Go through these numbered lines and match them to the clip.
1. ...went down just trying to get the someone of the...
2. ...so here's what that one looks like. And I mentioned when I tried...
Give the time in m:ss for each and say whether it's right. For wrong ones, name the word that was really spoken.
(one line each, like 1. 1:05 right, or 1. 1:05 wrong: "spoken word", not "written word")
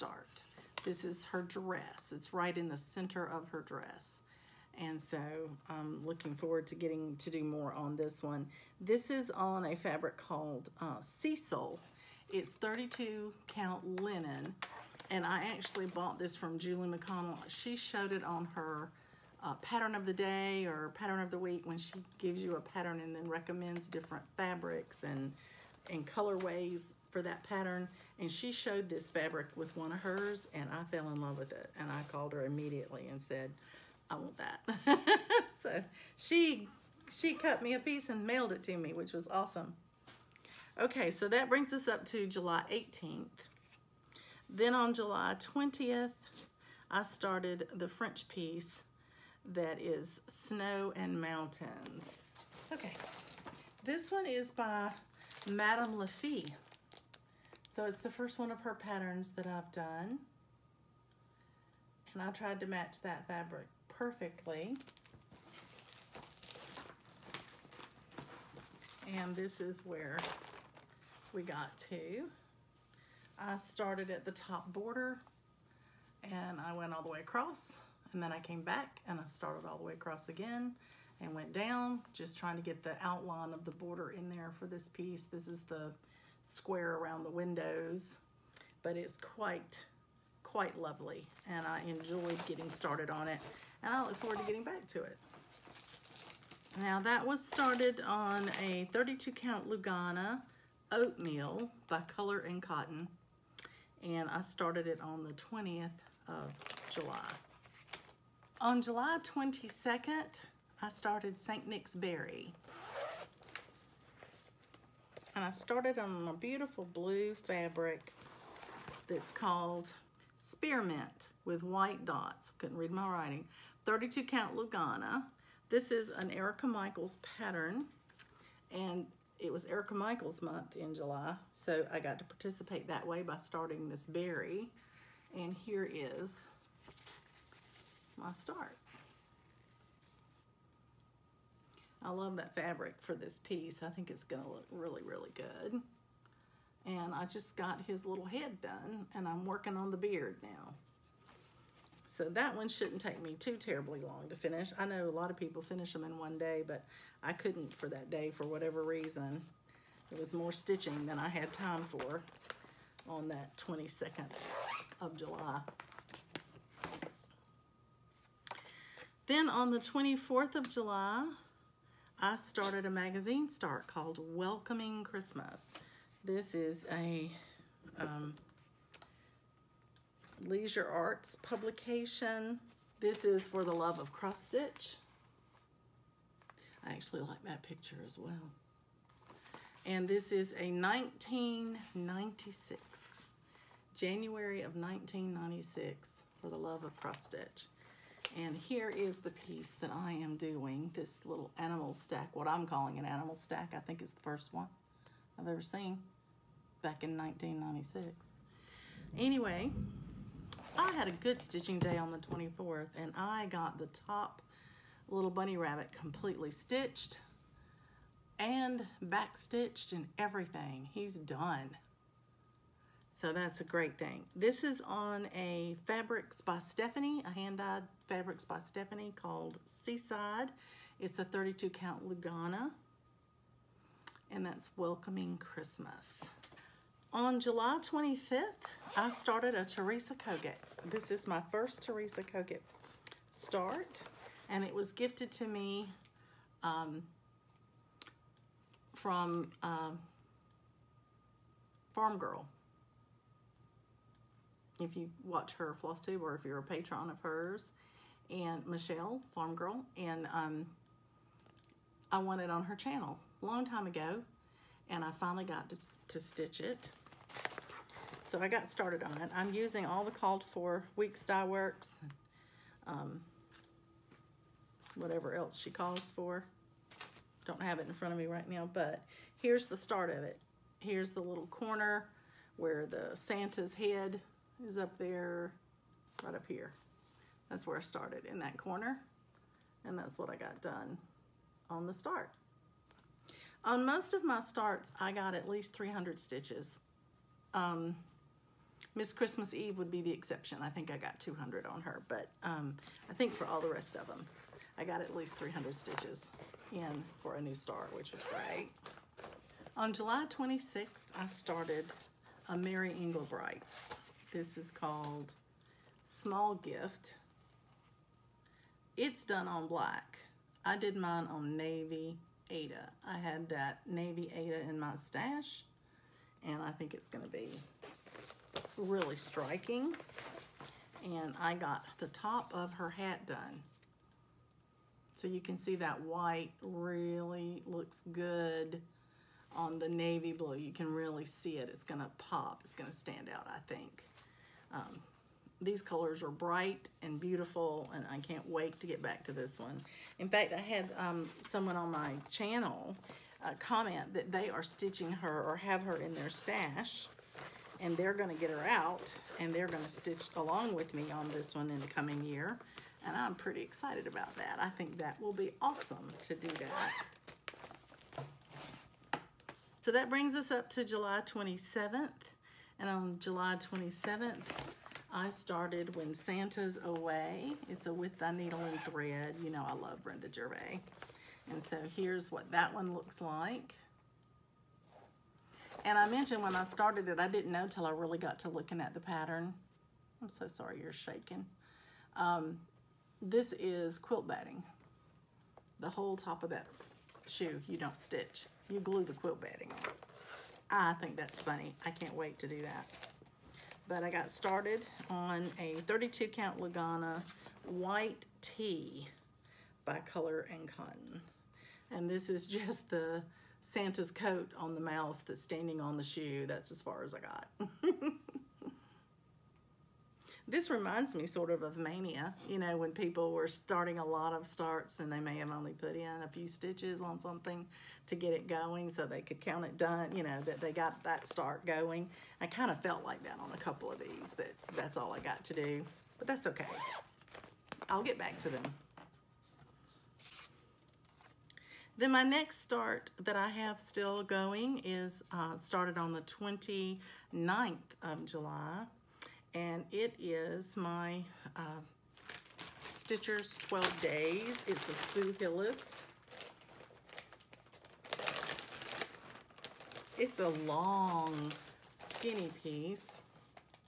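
1. 1:21 wrong: "outline", not "someone"
2. 6:21 wrong: "started", not "tried".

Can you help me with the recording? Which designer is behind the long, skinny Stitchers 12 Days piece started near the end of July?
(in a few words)
Sue Hillis.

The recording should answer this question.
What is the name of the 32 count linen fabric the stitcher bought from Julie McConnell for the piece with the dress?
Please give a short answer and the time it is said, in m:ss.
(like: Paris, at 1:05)
Cecil, at 0:11.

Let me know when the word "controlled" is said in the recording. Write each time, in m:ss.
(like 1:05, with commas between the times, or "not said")
not said.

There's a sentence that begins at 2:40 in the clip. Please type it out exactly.
It was more stitching than I had time for on that 22nd of July.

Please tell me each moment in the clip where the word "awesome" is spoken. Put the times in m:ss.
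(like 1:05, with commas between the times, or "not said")
0:39, 6:05.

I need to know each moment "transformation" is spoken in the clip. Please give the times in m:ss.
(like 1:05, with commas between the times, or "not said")
not said.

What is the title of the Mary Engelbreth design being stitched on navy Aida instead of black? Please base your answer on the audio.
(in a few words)
Small Gift.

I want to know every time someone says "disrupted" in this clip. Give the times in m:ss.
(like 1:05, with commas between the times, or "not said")
not said.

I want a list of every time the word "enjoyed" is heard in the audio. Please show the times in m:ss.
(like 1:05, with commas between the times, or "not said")
1:31.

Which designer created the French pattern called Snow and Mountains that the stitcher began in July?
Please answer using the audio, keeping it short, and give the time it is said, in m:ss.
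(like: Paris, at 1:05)
Madame Lafitte, at 0:55.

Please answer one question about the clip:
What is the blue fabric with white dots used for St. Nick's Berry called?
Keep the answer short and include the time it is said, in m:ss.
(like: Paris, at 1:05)
Spearmint, at 2:00.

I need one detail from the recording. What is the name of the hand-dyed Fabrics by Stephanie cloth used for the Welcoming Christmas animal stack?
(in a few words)
Seaside.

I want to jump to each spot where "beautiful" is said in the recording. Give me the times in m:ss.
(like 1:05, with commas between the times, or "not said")
1:56, 5:47.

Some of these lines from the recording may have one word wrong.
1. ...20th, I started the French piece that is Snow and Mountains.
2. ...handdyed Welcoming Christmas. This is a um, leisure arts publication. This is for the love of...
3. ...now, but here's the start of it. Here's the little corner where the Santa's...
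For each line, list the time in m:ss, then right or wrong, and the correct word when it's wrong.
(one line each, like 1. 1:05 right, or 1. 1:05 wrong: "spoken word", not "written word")
1. 0:45 right
2. 2:53 wrong: "called", not "handdyed"
3. 4:38 right.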